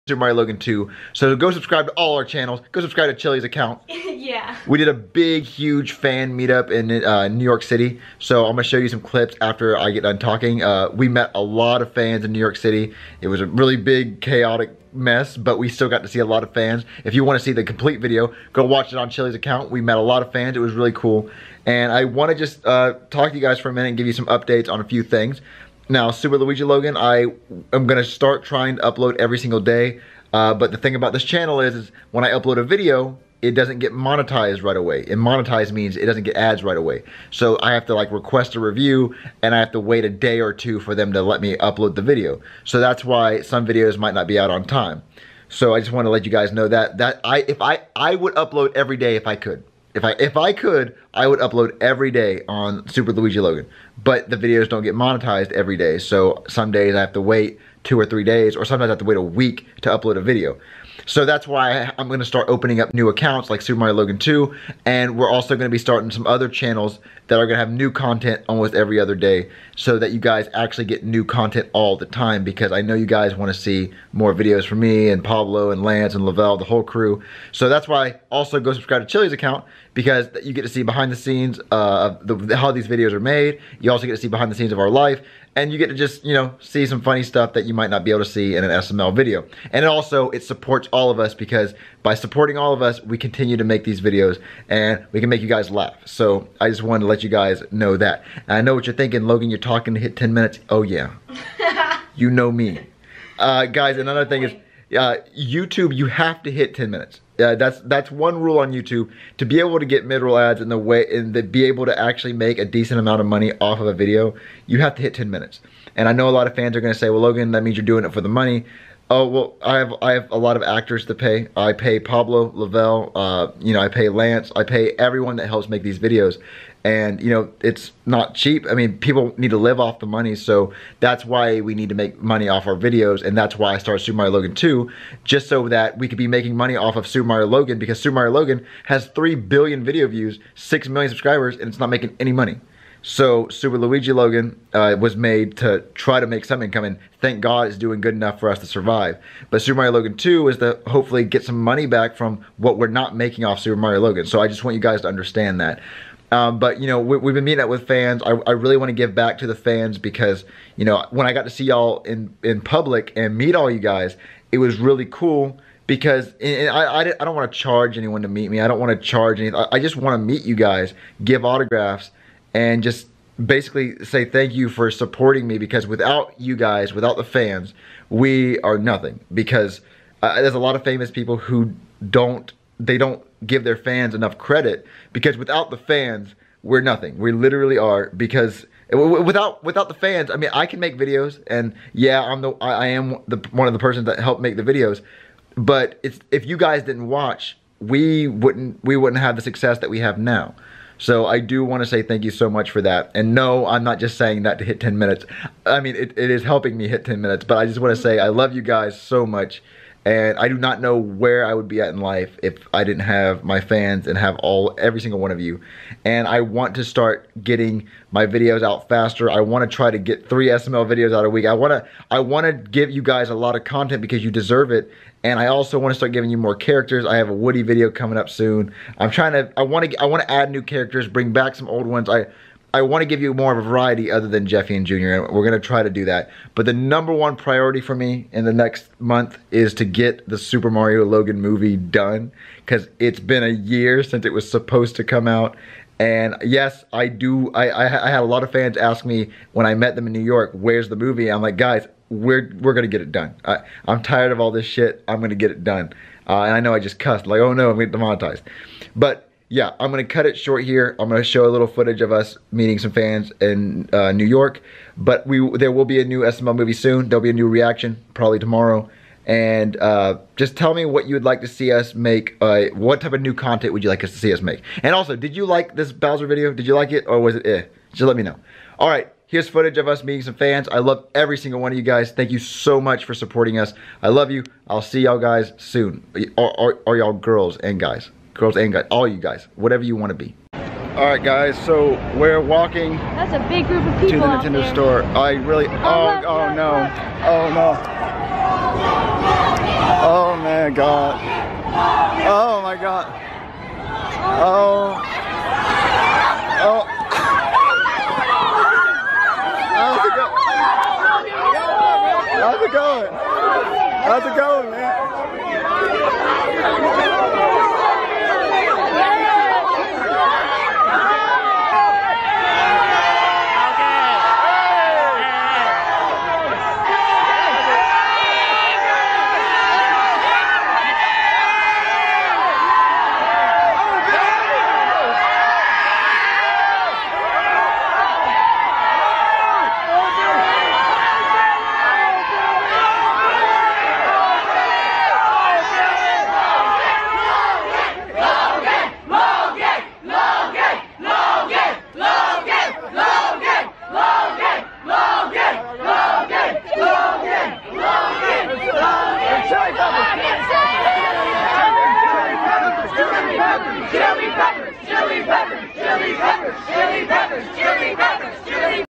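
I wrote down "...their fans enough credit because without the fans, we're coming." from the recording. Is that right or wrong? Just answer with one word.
wrong.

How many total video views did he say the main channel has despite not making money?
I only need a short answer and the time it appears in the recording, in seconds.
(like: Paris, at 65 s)
3 billion, at 139 s.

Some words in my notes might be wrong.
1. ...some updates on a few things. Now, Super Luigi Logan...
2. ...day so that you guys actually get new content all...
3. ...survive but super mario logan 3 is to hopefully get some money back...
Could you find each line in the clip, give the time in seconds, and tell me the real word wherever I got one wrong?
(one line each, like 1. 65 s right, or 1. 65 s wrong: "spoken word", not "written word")
1. 24 s right
2. 69 s right
3. 148 s wrong: "2", not "3".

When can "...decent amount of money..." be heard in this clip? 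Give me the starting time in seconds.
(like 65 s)
112 s.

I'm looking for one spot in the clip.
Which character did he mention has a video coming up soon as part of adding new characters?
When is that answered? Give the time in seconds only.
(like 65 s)
227 s.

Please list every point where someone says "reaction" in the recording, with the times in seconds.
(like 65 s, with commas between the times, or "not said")
267 s.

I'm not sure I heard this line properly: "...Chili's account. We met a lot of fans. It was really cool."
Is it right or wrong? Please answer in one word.
right.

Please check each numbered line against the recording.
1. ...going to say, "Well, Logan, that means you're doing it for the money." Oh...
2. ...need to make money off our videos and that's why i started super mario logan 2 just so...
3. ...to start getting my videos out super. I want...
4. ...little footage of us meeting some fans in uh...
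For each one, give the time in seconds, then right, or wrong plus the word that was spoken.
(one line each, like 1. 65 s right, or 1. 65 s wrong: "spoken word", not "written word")
1. 116 s right
2. 131 s right
3. 216 s wrong: "faster", not "super"
4. 261 s right.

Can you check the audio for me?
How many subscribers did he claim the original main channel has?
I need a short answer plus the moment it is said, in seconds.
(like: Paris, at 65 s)
6 million, at 140 s.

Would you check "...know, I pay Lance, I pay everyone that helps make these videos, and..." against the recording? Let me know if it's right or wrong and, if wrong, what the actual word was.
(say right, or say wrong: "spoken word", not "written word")
right.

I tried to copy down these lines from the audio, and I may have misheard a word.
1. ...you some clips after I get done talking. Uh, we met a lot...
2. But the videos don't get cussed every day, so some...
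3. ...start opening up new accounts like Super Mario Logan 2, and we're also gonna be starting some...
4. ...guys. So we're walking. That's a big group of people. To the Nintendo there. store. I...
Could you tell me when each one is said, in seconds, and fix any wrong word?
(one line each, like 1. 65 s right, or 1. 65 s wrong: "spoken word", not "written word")
1. 8 s right
2. 54 s wrong: "monetized", not "cussed"
3. 62 s right
4. 291 s right.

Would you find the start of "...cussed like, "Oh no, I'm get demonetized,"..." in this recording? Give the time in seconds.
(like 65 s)
256 s.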